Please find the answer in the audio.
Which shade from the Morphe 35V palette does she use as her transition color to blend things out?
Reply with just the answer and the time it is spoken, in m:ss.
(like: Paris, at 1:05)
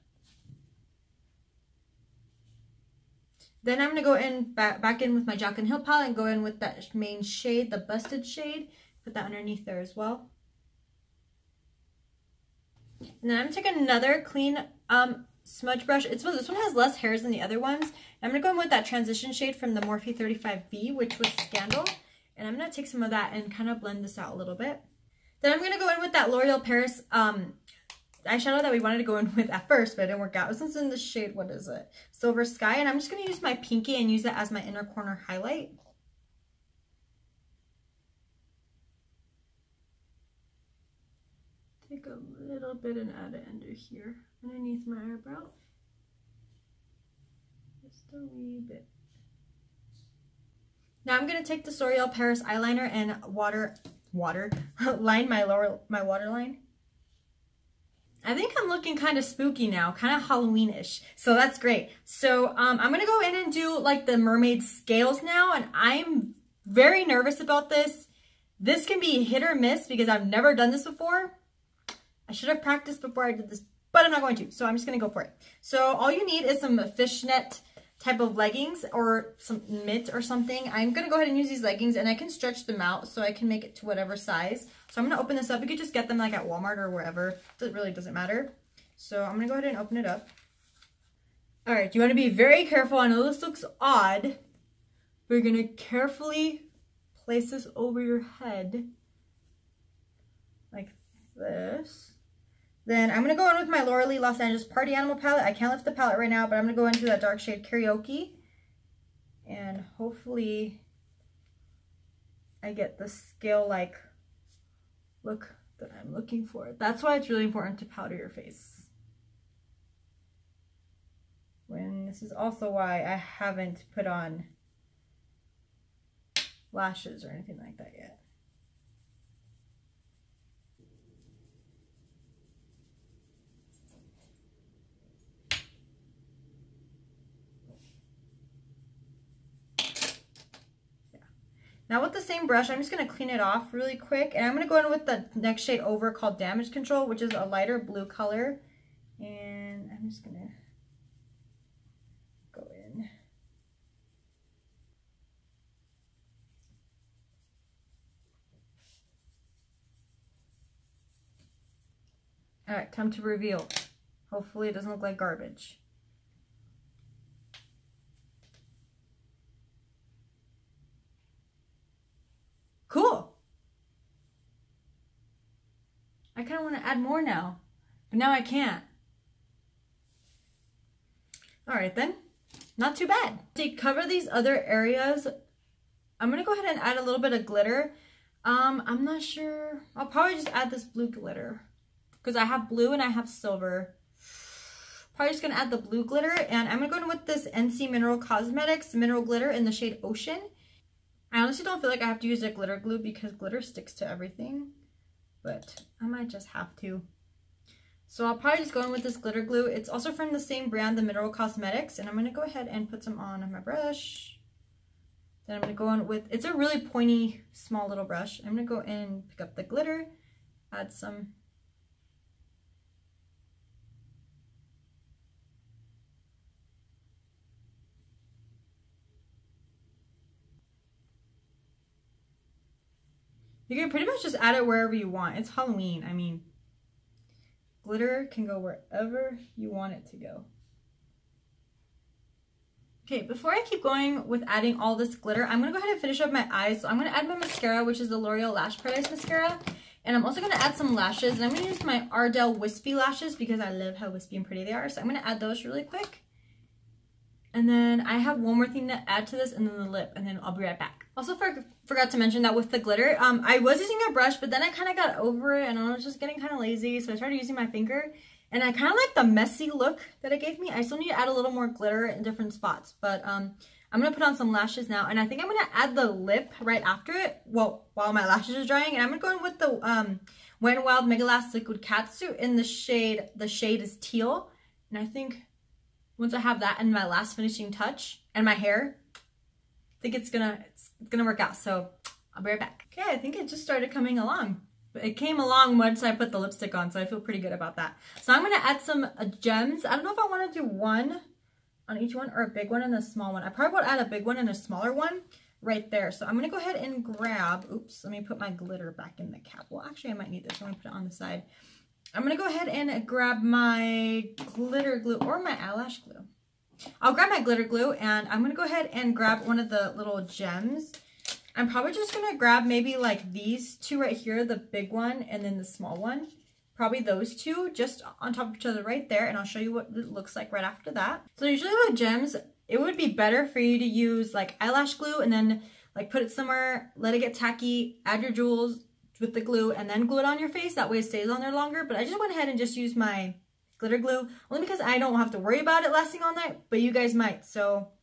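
Scandal, at 0:21.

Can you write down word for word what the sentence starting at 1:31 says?
All right, you want to be very careful.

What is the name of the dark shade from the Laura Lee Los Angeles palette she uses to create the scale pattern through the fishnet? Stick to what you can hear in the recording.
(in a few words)
Karaoke.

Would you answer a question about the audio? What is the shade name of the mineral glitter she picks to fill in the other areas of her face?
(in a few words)
Ocean.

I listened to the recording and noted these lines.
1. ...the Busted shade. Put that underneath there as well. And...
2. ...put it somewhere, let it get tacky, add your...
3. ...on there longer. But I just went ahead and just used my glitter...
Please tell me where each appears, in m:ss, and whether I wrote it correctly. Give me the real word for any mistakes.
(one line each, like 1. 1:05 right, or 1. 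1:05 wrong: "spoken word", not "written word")
1. 0:07 right
2. 5:36 right
3. 5:41 right.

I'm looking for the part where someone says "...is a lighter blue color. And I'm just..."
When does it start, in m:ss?
2:27.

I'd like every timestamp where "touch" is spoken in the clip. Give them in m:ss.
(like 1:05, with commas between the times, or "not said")
4:47.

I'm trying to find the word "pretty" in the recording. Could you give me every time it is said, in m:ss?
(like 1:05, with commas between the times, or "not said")
3:53, 4:14, 4:57.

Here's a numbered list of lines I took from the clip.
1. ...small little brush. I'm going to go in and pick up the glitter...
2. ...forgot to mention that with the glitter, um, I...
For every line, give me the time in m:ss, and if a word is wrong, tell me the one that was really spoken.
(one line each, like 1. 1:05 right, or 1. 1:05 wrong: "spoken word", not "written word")
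1. 3:37 right
2. 4:21 right.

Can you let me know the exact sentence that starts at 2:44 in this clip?
Hopefully it doesn't look like garbage.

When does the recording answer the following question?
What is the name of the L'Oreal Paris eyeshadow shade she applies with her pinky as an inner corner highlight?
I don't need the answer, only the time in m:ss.
0:32.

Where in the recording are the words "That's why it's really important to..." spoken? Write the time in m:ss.
1:56.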